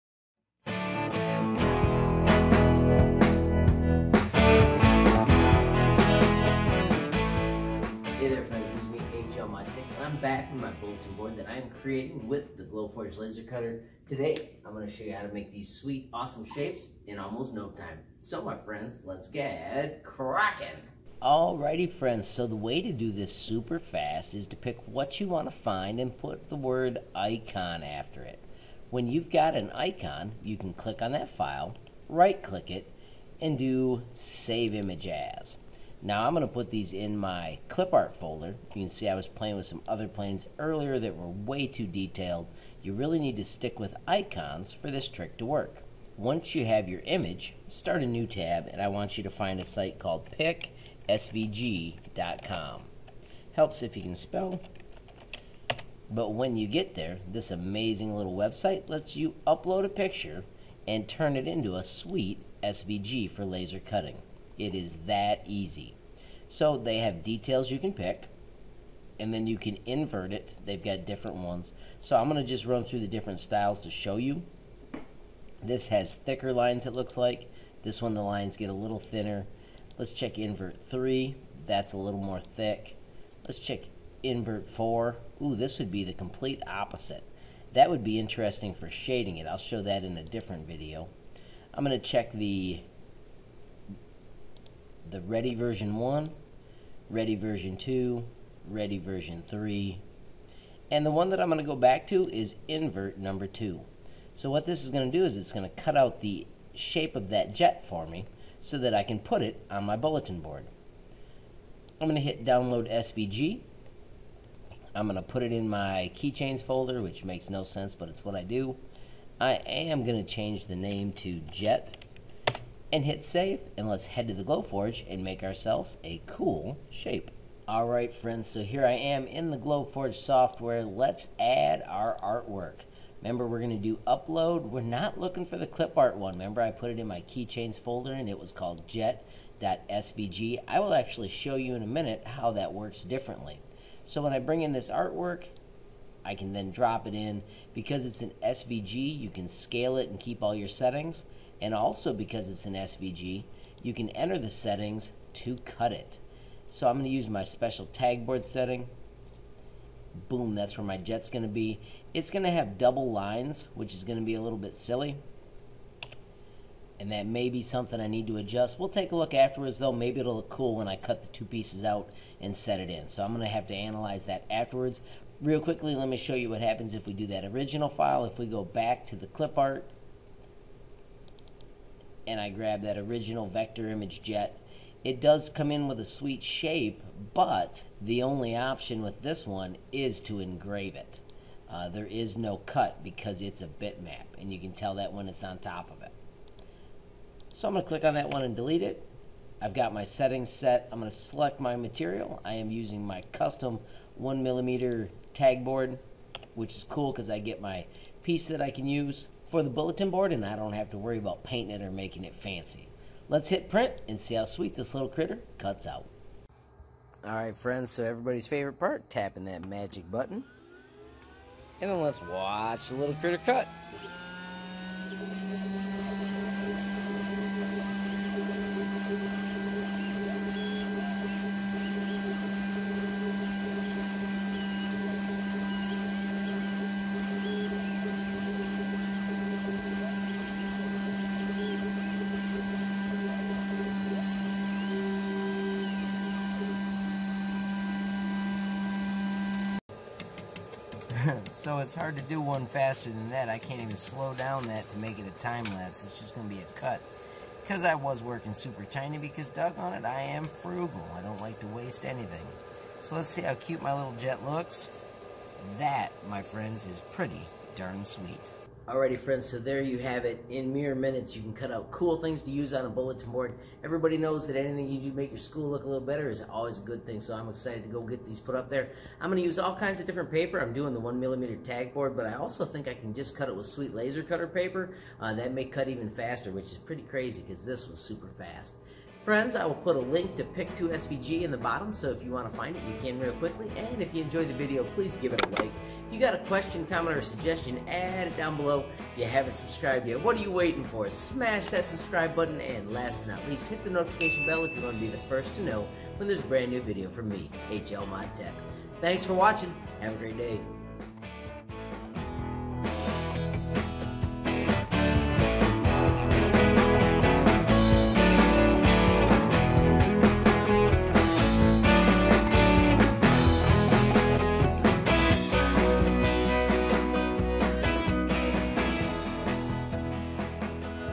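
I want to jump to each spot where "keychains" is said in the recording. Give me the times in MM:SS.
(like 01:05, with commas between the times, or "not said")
01:56, 02:17.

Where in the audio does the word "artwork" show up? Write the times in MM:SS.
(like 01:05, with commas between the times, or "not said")
02:12, 02:24.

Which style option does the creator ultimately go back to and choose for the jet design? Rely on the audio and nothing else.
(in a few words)
invert number 2.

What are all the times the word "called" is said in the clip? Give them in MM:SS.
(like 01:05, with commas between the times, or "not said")
00:49, 02:18.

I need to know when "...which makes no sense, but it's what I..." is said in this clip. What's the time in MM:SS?
01:57.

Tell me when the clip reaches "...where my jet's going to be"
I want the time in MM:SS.
02:40.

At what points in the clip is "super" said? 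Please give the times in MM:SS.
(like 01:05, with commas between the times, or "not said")
00:23, 04:18, 04:47.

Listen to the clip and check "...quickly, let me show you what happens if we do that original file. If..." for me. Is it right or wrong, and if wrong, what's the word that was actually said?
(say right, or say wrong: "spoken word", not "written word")
right.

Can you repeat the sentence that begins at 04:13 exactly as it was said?
I can't even slow down that to make it a time lapse.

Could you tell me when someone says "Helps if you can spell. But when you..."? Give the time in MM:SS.
00:53.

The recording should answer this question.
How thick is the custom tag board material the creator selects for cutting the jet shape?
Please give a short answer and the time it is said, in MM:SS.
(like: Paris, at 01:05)
1 millimeter, at 03:24.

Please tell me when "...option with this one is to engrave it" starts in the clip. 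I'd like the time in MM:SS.
03:08.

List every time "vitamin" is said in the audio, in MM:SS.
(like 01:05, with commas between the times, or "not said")
not said.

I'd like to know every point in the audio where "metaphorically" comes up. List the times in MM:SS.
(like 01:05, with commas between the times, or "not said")
not said.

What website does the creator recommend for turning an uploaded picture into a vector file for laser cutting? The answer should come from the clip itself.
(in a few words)
picsvg.com.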